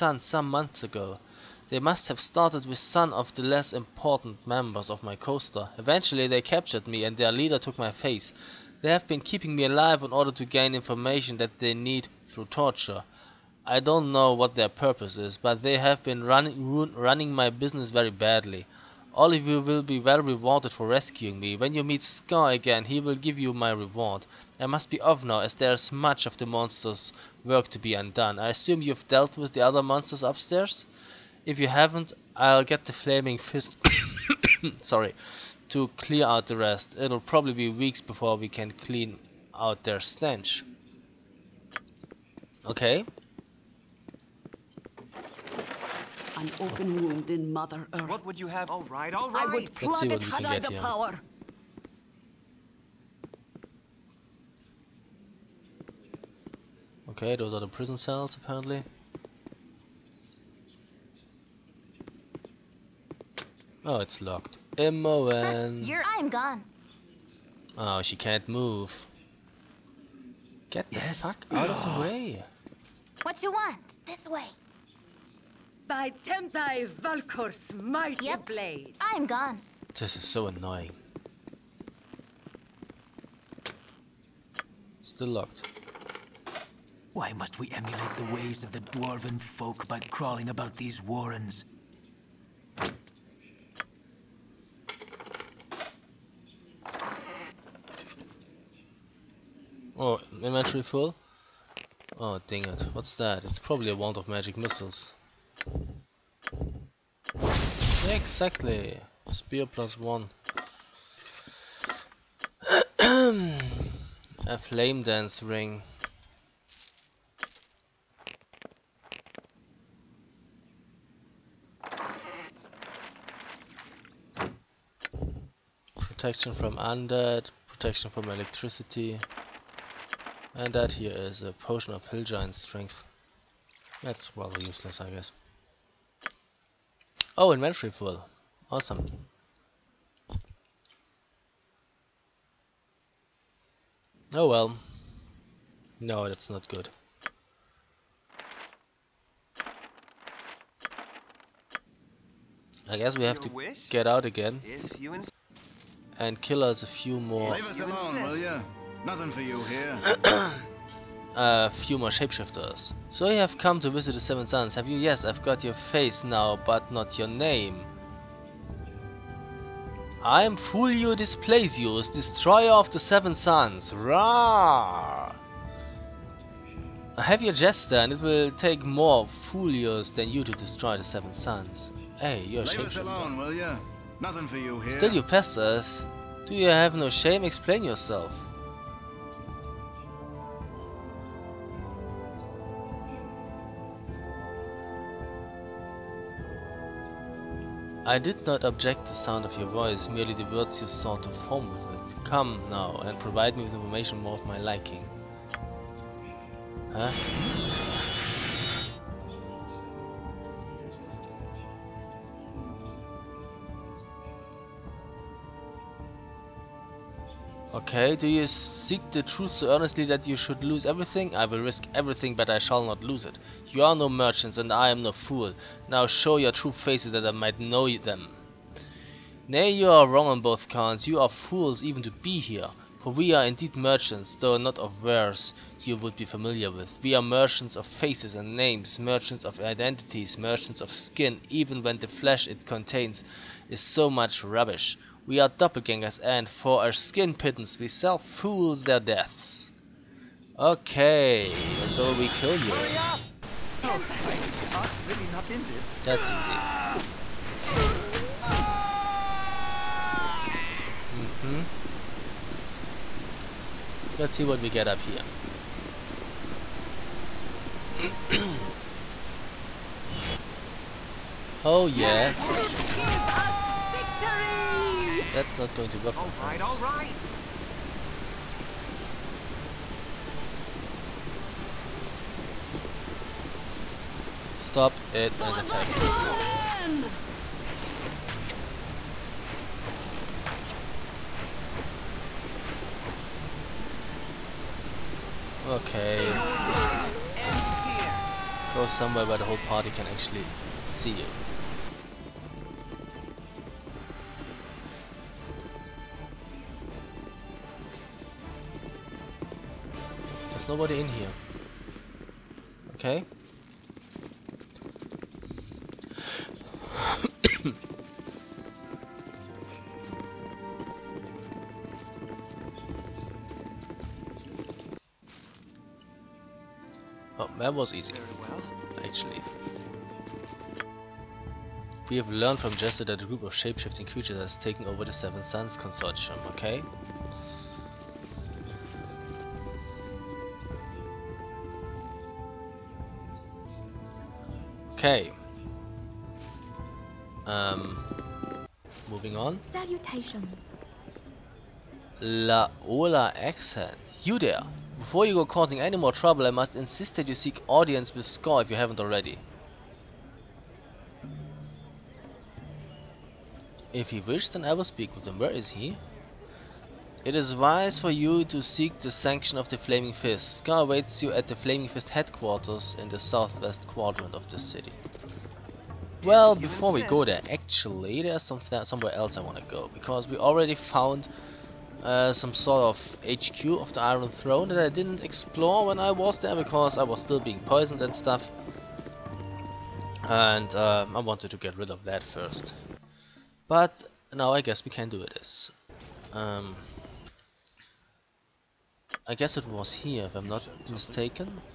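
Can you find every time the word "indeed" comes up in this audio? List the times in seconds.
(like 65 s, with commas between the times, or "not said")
233 s.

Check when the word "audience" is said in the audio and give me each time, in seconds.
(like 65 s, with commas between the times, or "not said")
357 s.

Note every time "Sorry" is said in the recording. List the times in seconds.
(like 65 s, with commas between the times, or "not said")
34 s.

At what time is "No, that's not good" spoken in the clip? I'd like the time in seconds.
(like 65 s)
145 s.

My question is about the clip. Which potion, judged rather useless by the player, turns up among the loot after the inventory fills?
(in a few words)
Potion of hill giant strength.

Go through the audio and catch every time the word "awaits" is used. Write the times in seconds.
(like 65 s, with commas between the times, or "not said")
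370 s.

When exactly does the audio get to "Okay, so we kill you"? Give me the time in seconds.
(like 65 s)
250 s.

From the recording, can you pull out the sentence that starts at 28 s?
I assume you've dealt with the other monsters upstairs?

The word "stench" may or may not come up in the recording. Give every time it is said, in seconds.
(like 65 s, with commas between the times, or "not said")
39 s.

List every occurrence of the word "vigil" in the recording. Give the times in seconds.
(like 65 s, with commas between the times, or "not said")
not said.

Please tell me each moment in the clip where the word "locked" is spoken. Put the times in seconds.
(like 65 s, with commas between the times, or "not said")
64 s, 85 s.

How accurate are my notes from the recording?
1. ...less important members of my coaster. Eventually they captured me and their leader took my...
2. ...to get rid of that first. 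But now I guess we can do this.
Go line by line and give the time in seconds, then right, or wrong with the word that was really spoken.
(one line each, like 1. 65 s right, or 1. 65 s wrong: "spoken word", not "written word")
1. 3 s right
2. 391 s right.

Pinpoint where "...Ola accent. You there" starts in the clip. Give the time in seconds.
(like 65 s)
352 s.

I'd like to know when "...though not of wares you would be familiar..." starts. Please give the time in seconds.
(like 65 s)
234 s.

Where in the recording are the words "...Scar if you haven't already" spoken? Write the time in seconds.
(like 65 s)
358 s.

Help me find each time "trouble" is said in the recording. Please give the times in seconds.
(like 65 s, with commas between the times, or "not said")
356 s.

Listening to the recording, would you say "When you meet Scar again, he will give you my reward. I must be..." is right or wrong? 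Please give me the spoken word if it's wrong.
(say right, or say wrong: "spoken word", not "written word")
right.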